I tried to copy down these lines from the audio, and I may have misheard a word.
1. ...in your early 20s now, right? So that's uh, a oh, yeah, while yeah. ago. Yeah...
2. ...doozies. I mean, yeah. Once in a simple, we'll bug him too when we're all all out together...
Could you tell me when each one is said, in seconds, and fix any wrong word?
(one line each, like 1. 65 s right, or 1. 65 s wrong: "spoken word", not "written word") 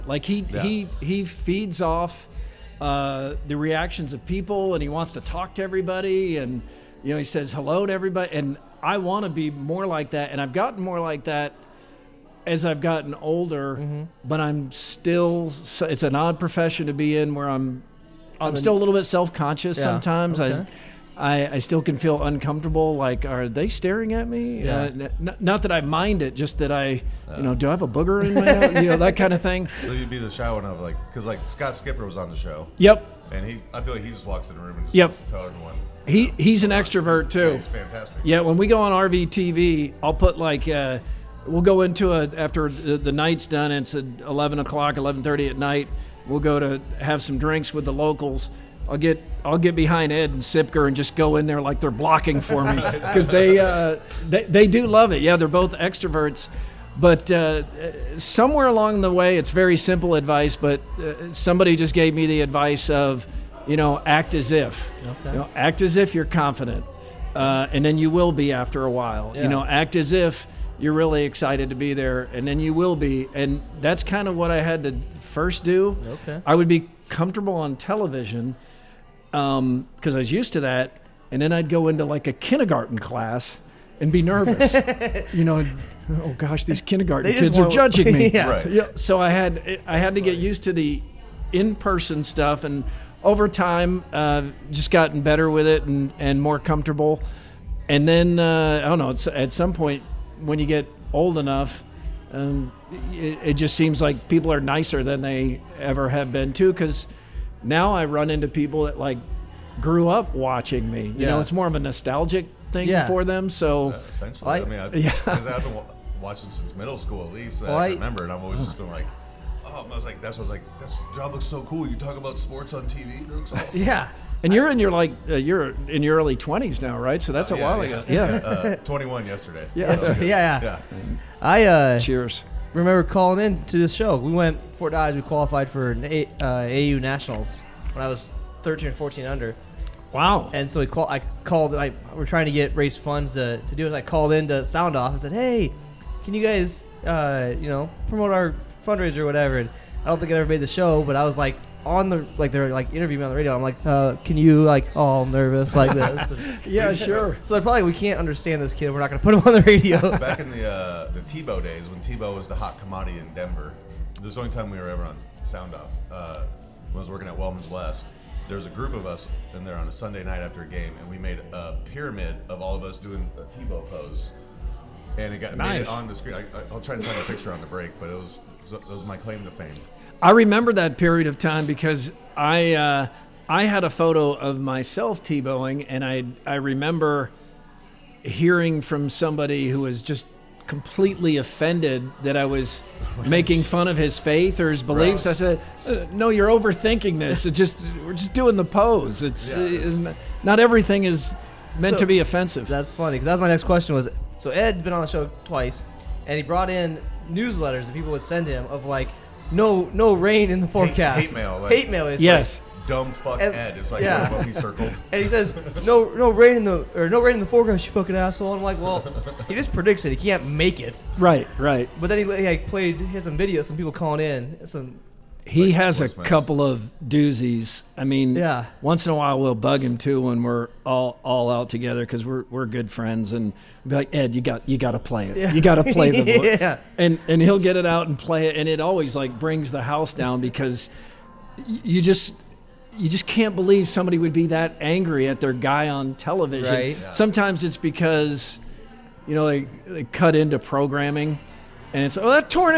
1. 125 s right
2. 227 s wrong: "while", not "simple".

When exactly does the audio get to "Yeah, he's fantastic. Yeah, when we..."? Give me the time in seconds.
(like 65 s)
37 s.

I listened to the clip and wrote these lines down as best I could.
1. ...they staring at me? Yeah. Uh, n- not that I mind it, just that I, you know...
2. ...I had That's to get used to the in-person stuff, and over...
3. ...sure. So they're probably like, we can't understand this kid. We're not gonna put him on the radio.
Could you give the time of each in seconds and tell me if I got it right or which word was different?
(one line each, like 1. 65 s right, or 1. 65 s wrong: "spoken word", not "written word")
1. 23 s right
2. 89 s right
3. 156 s right.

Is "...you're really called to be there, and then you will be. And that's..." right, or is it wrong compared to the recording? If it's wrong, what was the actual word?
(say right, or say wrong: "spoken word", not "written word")
wrong: "excited", not "called".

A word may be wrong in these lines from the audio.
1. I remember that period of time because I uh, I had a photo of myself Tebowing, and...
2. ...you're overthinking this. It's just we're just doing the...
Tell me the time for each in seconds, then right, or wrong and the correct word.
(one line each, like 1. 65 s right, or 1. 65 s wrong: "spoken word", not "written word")
1. 180 s right
2. 196 s right.